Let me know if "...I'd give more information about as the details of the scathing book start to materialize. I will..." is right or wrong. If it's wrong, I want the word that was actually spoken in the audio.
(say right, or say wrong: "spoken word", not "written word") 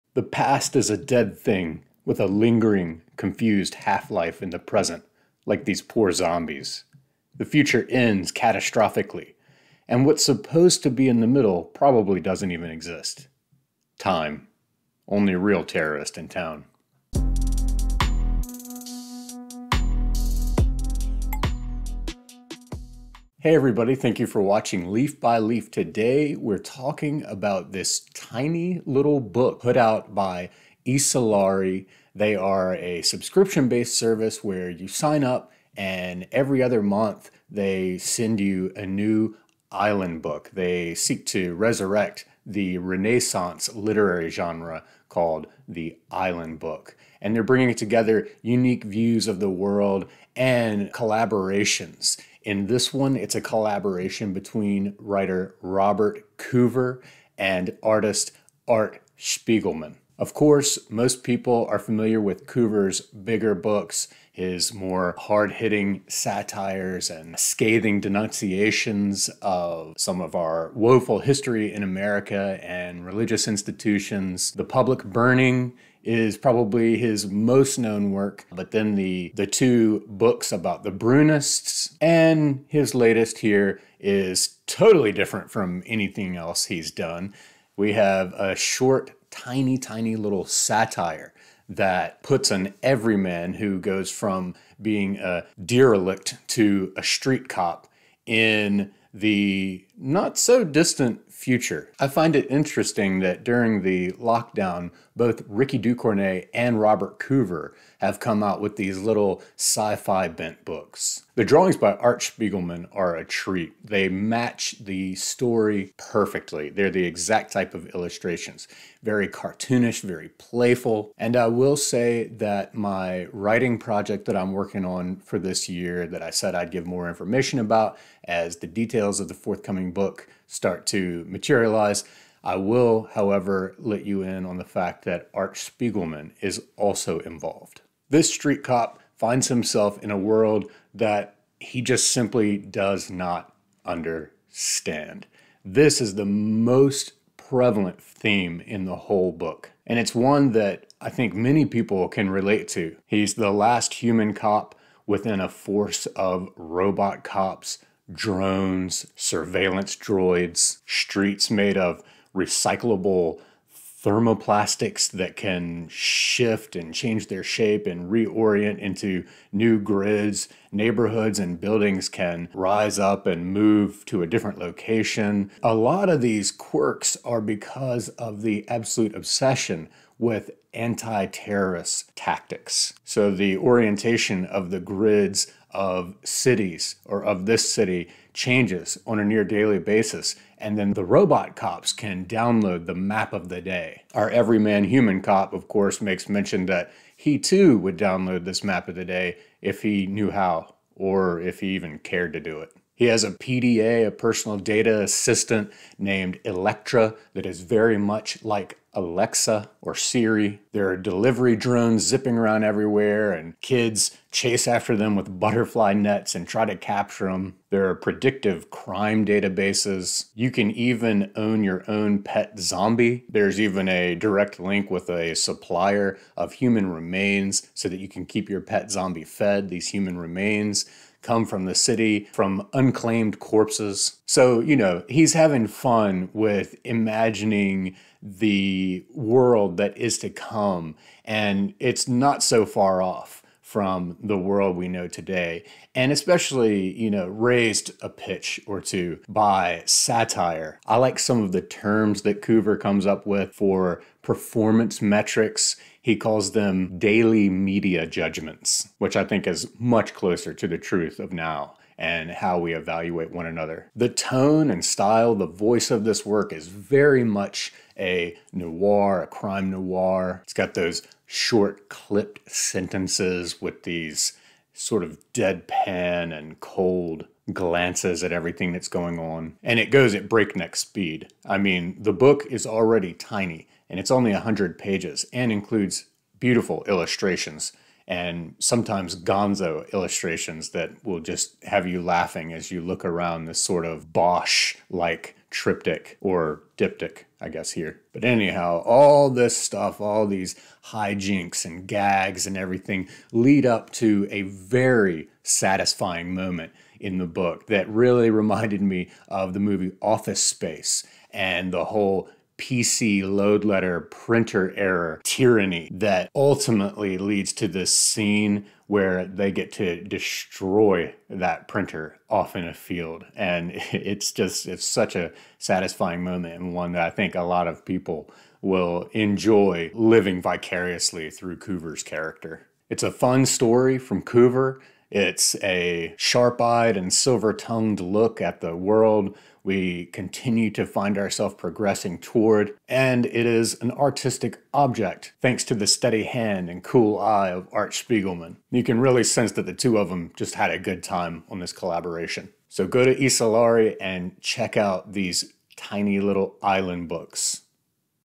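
wrong: "forthcoming", not "scathing".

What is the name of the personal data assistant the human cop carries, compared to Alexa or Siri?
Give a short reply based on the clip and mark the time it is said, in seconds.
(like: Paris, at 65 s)
Electra, at 206 s.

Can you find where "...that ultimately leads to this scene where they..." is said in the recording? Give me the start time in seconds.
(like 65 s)
315 s.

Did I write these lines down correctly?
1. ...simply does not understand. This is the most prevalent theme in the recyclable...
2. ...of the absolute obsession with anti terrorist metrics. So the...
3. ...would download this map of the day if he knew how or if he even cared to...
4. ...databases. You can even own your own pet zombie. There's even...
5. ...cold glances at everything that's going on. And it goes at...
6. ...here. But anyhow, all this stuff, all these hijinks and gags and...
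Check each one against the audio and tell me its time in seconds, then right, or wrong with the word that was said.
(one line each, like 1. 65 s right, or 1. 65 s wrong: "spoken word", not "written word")
1. 142 s wrong: "whole", not "recyclable"
2. 178 s wrong: "tactics", not "metrics"
3. 197 s right
4. 219 s right
5. 276 s right
6. 297 s right.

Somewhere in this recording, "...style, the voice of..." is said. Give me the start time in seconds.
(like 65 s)
264 s.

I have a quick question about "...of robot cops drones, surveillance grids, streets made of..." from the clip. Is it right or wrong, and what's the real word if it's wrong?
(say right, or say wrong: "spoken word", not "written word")
wrong: "droids", not "grids".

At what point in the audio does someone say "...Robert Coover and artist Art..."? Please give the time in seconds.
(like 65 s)
55 s.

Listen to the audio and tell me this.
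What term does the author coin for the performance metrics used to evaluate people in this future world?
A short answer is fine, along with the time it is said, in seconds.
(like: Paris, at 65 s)
daily media judgments, at 256 s.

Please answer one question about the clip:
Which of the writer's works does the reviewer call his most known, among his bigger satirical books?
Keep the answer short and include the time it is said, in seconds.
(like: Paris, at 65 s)
The Public Burning, at 74 s.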